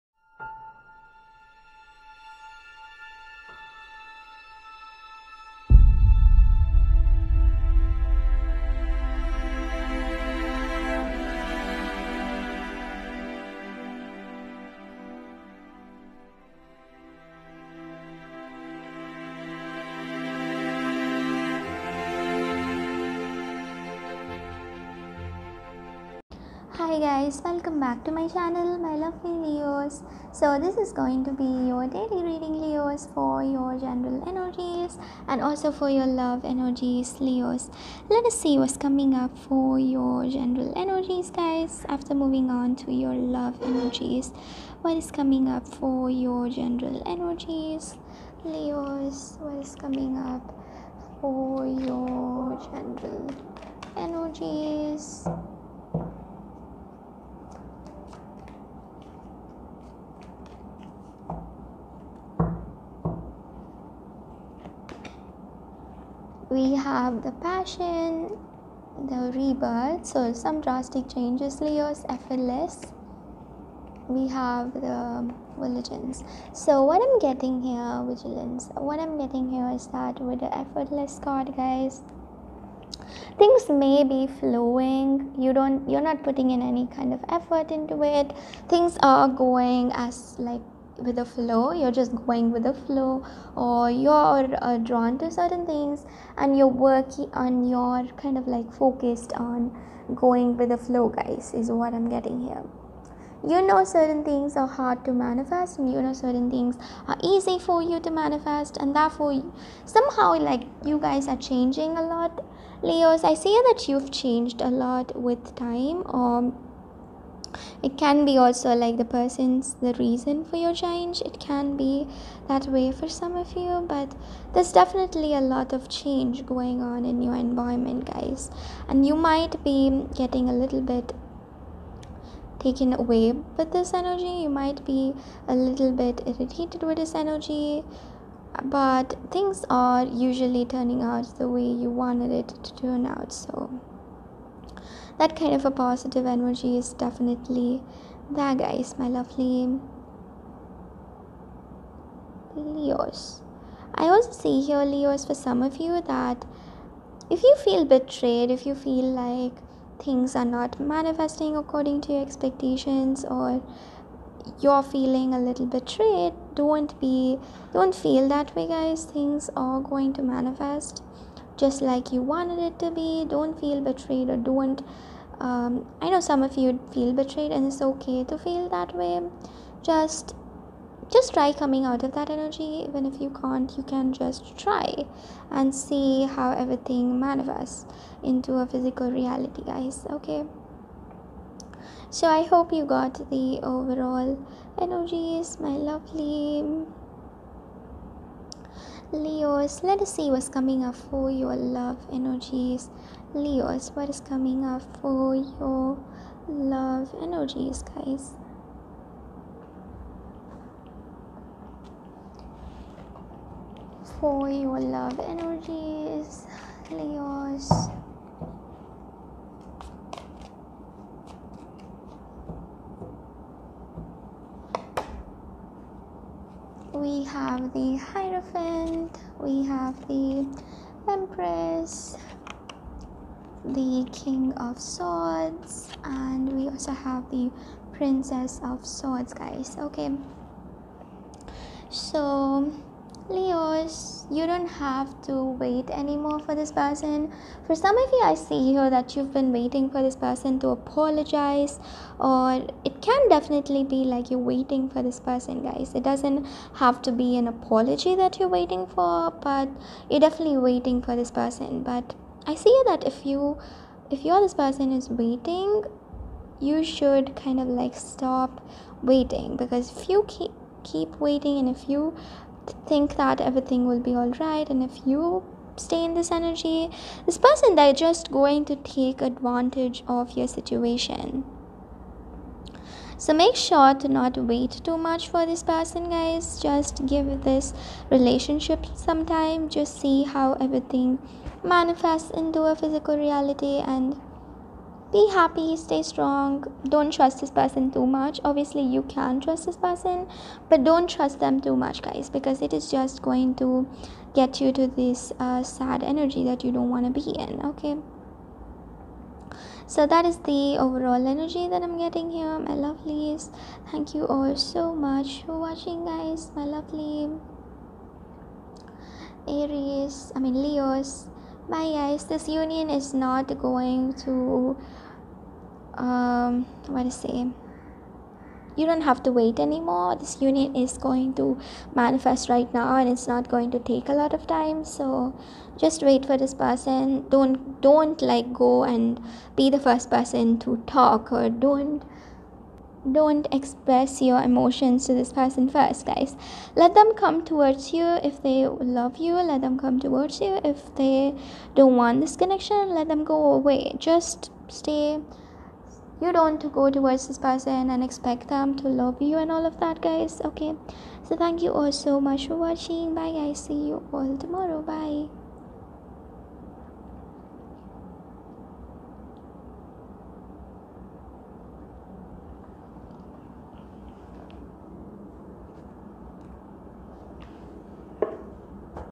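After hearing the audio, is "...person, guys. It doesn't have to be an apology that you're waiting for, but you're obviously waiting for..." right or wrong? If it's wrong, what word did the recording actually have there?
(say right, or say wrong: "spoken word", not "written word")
wrong: "definitely", not "obviously".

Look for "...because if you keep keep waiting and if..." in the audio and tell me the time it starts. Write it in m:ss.
4:29.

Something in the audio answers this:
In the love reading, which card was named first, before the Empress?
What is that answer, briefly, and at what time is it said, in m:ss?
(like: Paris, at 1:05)
The Hierophant, at 3:47.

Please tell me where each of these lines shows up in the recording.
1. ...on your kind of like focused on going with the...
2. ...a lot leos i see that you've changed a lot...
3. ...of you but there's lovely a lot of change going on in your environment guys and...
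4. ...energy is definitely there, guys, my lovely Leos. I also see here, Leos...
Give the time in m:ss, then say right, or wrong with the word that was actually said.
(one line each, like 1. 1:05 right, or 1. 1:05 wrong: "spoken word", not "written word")
1. 1:37 right
2. 1:51 right
3. 2:03 wrong: "definitely", not "lovely"
4. 2:26 right.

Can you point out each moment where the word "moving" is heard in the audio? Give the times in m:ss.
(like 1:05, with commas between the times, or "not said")
0:42.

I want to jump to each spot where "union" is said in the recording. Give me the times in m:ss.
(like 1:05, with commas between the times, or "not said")
5:22, 5:30.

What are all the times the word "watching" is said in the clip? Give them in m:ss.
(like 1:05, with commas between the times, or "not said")
5:15, 6:02.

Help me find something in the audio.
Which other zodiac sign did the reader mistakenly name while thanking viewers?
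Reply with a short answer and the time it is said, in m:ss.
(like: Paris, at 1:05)
Aries, at 5:19.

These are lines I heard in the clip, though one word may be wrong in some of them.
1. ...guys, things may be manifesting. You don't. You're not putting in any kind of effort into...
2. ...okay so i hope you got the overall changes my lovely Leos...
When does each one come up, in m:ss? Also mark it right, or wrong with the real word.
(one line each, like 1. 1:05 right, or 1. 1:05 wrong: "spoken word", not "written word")
1. 1:21 wrong: "flowing", not "manifesting"
2. 3:10 wrong: "energies", not "changes".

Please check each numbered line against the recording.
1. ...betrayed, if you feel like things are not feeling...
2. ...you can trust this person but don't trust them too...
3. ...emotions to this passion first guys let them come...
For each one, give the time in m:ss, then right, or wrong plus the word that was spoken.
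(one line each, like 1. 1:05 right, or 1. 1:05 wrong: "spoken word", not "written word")
1. 2:37 wrong: "manifesting", not "feeling"
2. 4:58 right
3. 5:44 wrong: "person", not "passion".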